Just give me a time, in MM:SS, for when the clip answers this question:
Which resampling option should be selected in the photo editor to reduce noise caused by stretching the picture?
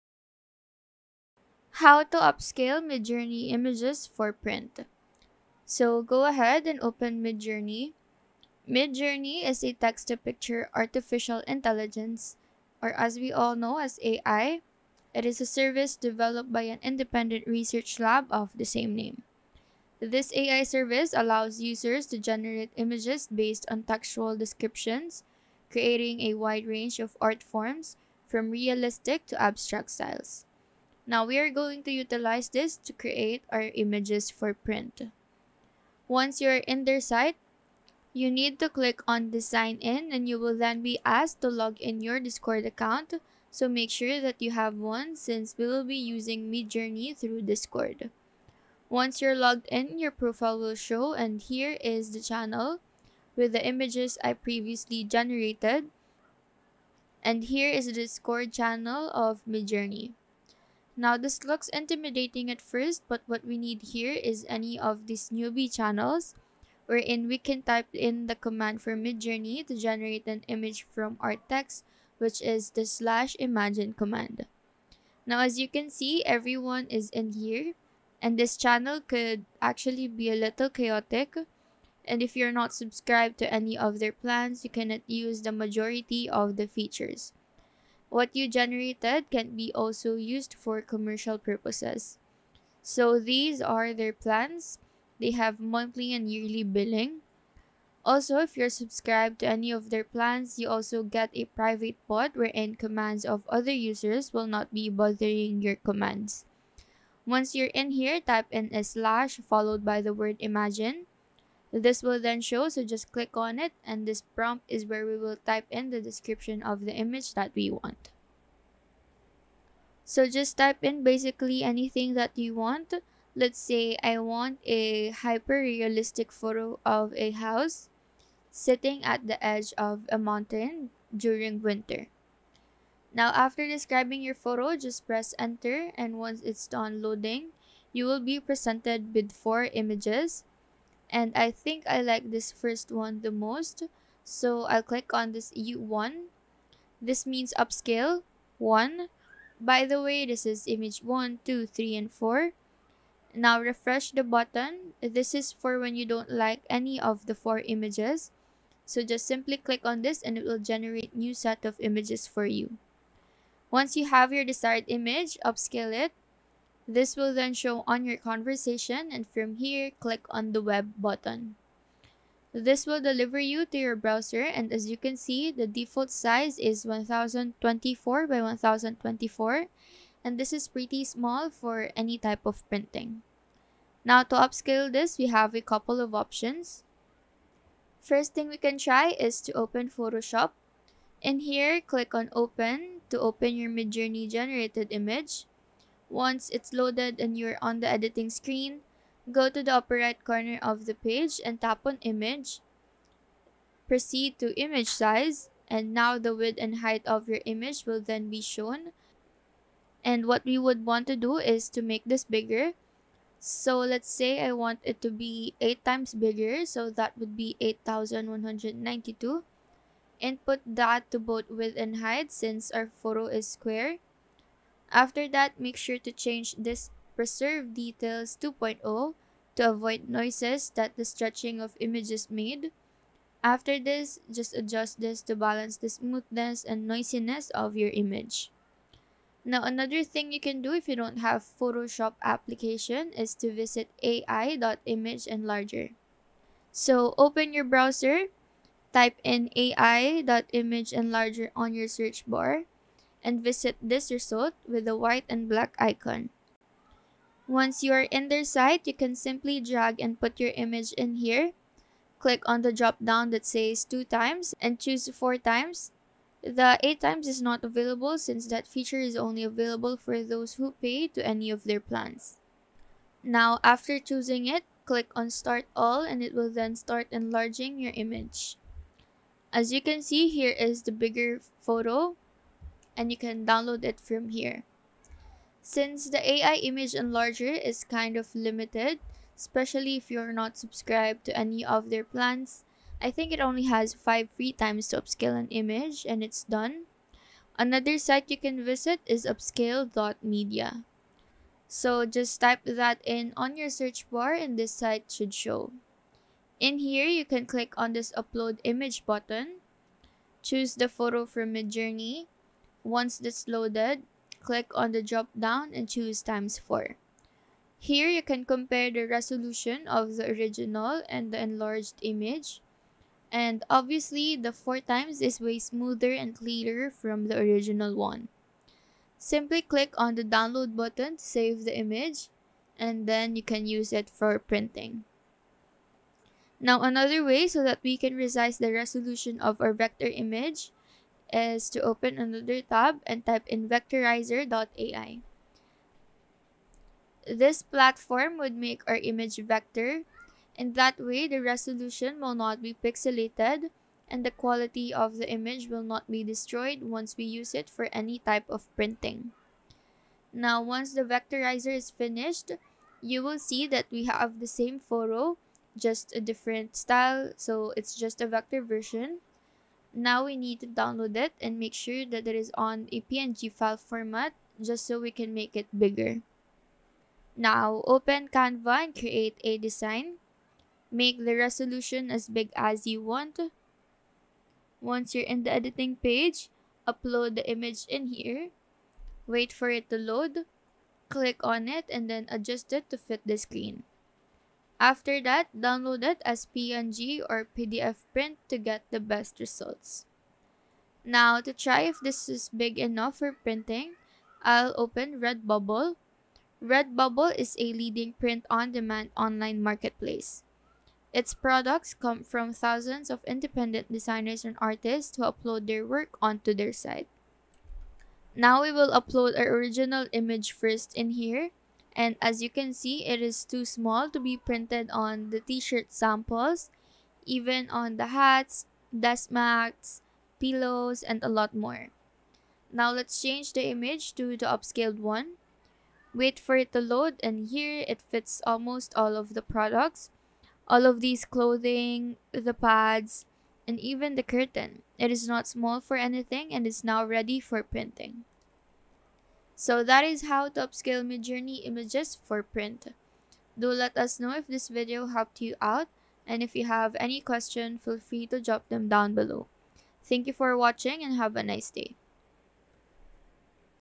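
03:47.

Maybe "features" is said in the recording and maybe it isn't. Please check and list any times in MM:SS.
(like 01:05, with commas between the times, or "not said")
01:26, 04:28.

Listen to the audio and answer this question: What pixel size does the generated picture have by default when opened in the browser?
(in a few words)
1024 by 1024.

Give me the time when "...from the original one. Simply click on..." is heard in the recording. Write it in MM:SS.
05:26.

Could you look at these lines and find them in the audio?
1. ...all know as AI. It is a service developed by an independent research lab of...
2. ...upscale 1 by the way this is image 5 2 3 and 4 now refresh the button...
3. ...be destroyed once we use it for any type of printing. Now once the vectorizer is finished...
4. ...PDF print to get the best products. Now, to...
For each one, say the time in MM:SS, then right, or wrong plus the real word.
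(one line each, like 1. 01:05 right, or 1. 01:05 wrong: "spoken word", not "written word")
1. 00:13 right
2. 02:27 wrong: "1", not "5"
3. 05:56 right
4. 06:37 wrong: "results", not "products".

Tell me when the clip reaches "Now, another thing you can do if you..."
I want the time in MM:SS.
03:59.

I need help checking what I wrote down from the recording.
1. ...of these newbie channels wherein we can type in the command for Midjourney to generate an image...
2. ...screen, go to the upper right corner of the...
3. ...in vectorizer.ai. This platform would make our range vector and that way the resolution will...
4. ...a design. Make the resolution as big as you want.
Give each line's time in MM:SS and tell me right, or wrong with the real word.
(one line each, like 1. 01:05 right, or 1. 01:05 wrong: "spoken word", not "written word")
1. 01:04 right
2. 03:18 right
3. 05:43 wrong: "image", not "range"
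4. 06:19 right.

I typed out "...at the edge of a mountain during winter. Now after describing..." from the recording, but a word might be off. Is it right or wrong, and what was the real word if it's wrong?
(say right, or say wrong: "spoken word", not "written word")
right.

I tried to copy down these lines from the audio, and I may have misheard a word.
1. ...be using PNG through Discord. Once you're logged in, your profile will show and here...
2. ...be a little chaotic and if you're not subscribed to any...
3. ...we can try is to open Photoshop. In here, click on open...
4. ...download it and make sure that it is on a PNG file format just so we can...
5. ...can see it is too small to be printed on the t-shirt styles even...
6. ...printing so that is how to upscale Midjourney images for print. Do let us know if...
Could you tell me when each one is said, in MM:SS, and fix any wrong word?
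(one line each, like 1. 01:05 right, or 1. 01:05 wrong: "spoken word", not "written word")
1. 00:45 wrong: "Midjourney", not "PNG"
2. 01:20 right
3. 03:08 right
4. 06:10 right
5. 07:02 wrong: "samples", not "styles"
6. 07:27 right.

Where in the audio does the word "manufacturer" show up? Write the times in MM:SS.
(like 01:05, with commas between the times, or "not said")
not said.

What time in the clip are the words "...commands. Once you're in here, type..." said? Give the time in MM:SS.
01:45.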